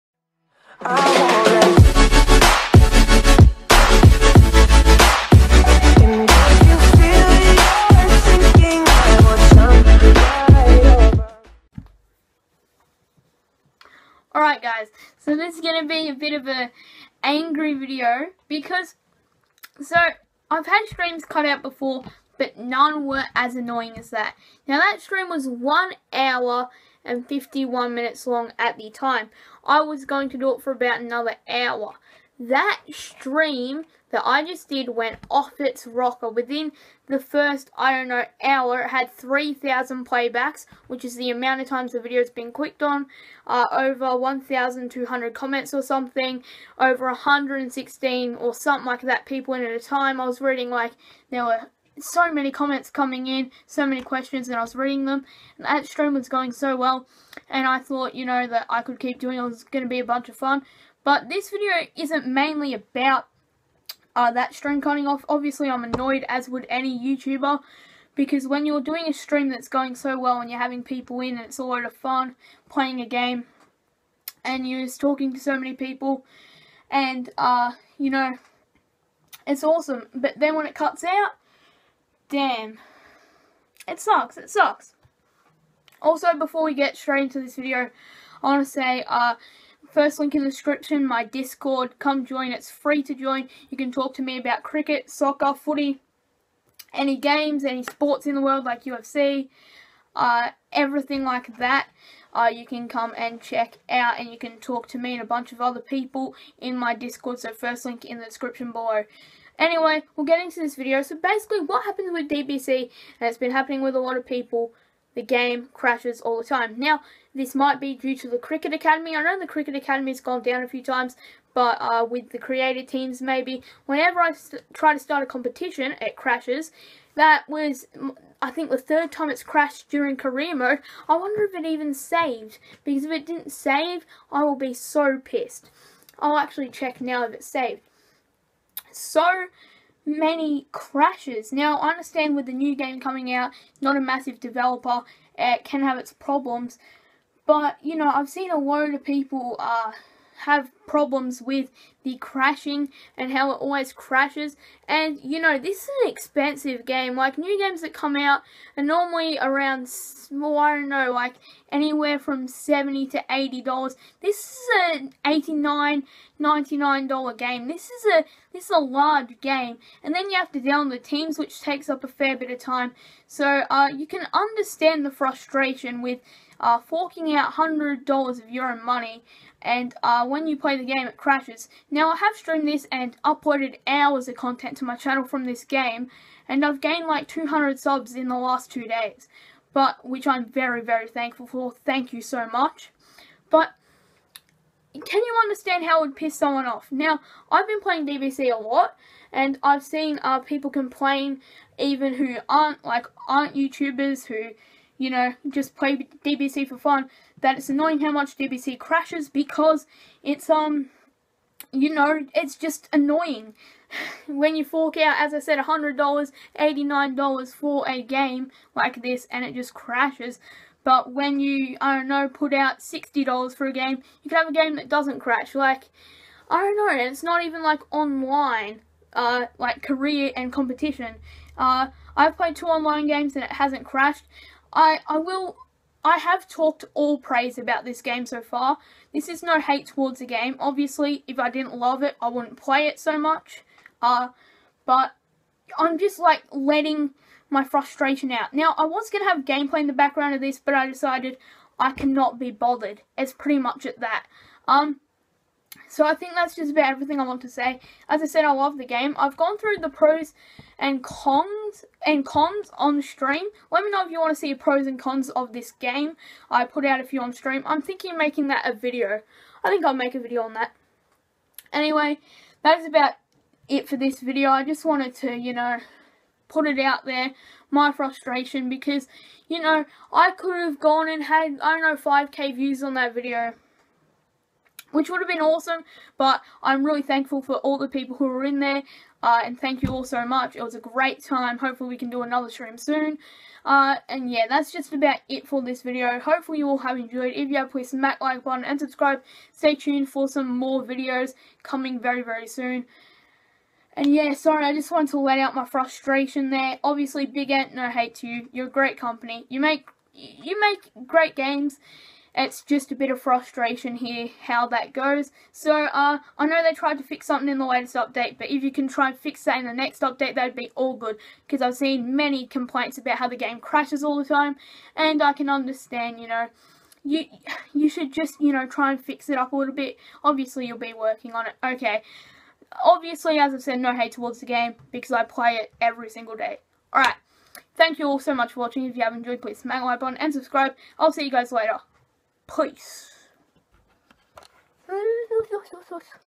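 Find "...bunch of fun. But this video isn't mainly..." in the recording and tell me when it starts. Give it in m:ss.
1:00.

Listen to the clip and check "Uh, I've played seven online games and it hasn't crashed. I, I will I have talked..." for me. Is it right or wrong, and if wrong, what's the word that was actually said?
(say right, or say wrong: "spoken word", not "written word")
wrong: "two", not "seven".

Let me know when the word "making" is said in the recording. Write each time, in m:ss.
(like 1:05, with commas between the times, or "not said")
4:28.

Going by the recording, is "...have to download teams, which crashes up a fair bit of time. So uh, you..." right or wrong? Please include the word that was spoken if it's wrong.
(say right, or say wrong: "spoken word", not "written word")
wrong: "takes", not "crashes".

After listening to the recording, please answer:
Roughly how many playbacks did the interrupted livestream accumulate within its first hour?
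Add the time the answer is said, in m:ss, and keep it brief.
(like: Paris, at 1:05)
3,000, at 0:39.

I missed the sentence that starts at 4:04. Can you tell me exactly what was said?
Uh, but I'm just like letting my frustration out.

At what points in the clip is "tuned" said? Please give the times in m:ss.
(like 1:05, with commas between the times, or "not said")
4:59.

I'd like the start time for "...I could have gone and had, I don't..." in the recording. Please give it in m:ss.
4:40.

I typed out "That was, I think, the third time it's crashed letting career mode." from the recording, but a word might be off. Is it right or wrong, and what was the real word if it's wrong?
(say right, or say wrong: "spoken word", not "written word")
wrong: "during", not "letting".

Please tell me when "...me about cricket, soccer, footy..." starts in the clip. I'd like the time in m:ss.
1:34.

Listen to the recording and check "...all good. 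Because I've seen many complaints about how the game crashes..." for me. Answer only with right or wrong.
right.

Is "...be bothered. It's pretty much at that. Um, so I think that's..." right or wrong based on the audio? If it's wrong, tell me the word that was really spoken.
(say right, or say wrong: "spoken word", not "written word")
right.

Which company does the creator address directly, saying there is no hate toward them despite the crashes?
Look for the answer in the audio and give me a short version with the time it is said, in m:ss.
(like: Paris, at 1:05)
Big Ant, at 5:07.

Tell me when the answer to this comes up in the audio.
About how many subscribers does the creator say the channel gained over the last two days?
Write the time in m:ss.
3:07.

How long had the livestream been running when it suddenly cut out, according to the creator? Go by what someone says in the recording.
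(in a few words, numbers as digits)
1 hour and 51 minutes.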